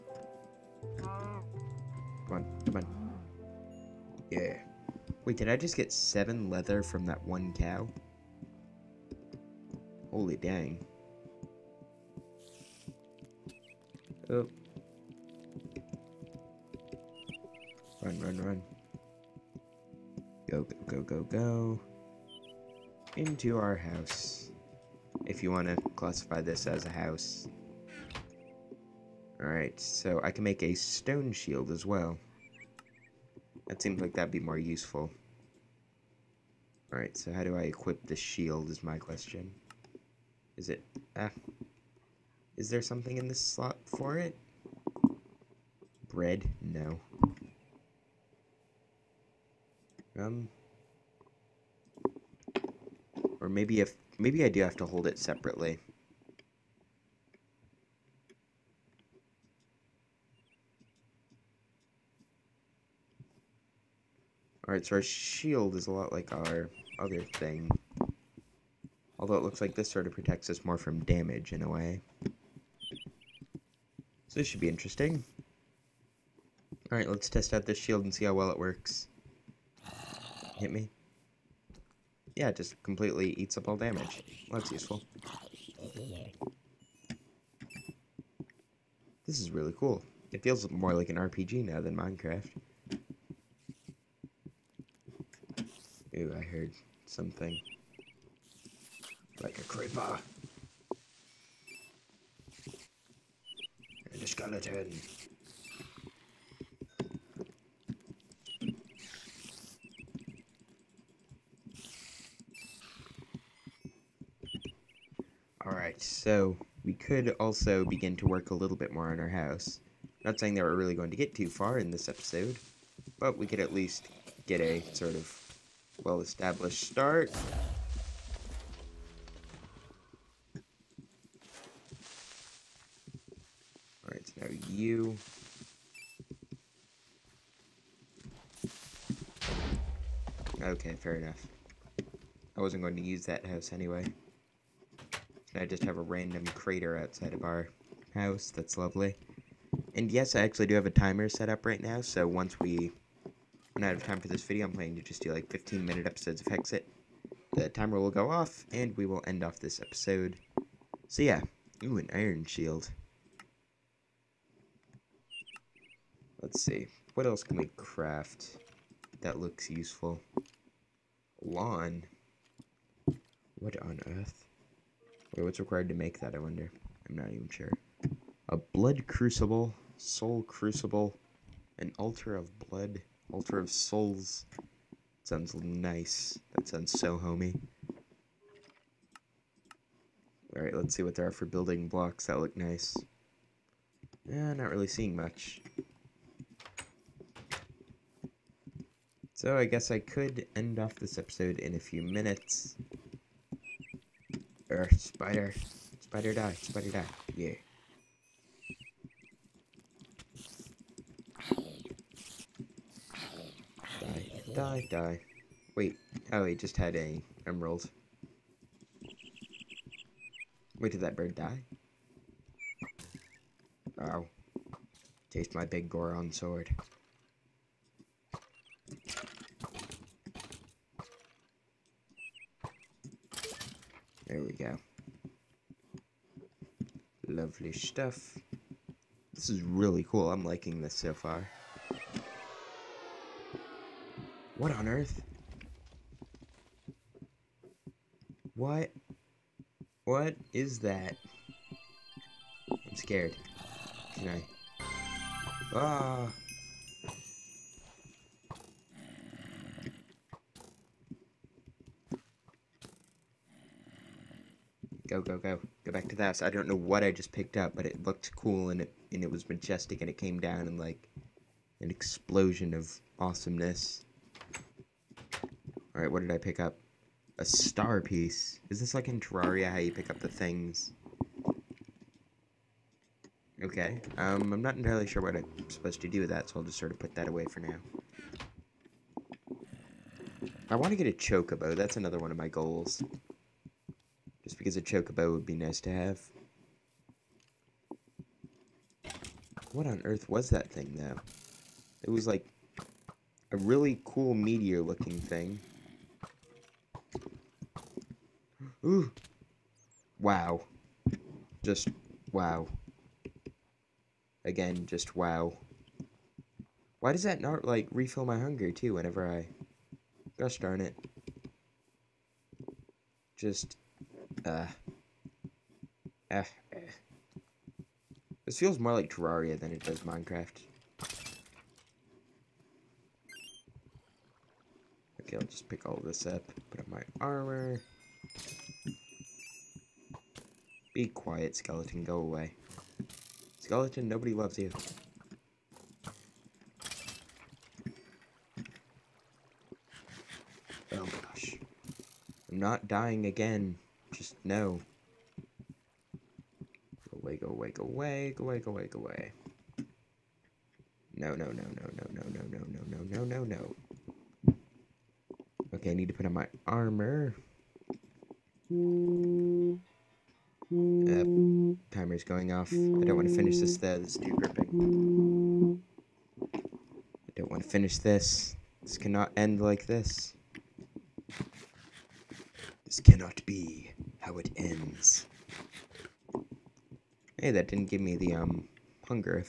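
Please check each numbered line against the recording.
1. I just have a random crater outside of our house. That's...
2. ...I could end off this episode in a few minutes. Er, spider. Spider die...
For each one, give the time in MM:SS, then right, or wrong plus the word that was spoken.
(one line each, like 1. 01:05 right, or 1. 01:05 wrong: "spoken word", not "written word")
1. 02:25 right
2. 03:19 right.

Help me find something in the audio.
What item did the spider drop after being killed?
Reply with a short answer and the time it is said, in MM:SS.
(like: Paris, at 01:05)
emerald, at 03:37.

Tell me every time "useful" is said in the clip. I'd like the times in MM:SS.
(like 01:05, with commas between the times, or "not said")
00:34, 01:24, 02:49.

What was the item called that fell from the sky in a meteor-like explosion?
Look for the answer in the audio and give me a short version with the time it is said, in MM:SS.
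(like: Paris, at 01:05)
star piece, at 04:37.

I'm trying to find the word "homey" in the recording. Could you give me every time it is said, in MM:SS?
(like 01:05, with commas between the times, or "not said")
03:07.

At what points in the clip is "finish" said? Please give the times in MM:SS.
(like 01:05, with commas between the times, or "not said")
06:13, 06:17.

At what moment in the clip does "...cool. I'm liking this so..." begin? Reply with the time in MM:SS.
04:00.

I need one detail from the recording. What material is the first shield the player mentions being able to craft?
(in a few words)
stone.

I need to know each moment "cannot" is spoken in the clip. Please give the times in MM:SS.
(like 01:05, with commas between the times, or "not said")
06:18, 06:22.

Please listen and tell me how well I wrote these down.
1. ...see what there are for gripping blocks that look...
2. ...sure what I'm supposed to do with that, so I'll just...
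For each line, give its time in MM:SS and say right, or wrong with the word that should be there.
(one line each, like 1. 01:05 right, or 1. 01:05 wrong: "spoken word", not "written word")
1. 03:10 wrong: "building", not "gripping"
2. 04:45 right.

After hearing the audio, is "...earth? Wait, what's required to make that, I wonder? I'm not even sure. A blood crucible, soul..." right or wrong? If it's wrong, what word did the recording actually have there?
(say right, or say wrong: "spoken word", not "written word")
right.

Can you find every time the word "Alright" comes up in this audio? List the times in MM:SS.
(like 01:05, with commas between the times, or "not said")
00:29, 00:36, 01:04, 01:16, 01:55, 03:10, 04:35.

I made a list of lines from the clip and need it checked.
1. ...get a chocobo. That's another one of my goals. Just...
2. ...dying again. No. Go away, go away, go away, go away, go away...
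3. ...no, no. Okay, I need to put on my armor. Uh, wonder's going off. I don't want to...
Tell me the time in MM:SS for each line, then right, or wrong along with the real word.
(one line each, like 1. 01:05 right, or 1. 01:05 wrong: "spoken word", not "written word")
1. 04:50 right
2. 05:52 right
3. 06:03 wrong: "timer", not "wonder".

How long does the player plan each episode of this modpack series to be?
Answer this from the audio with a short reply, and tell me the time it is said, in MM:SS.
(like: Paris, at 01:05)
15 minutes, at 02:35.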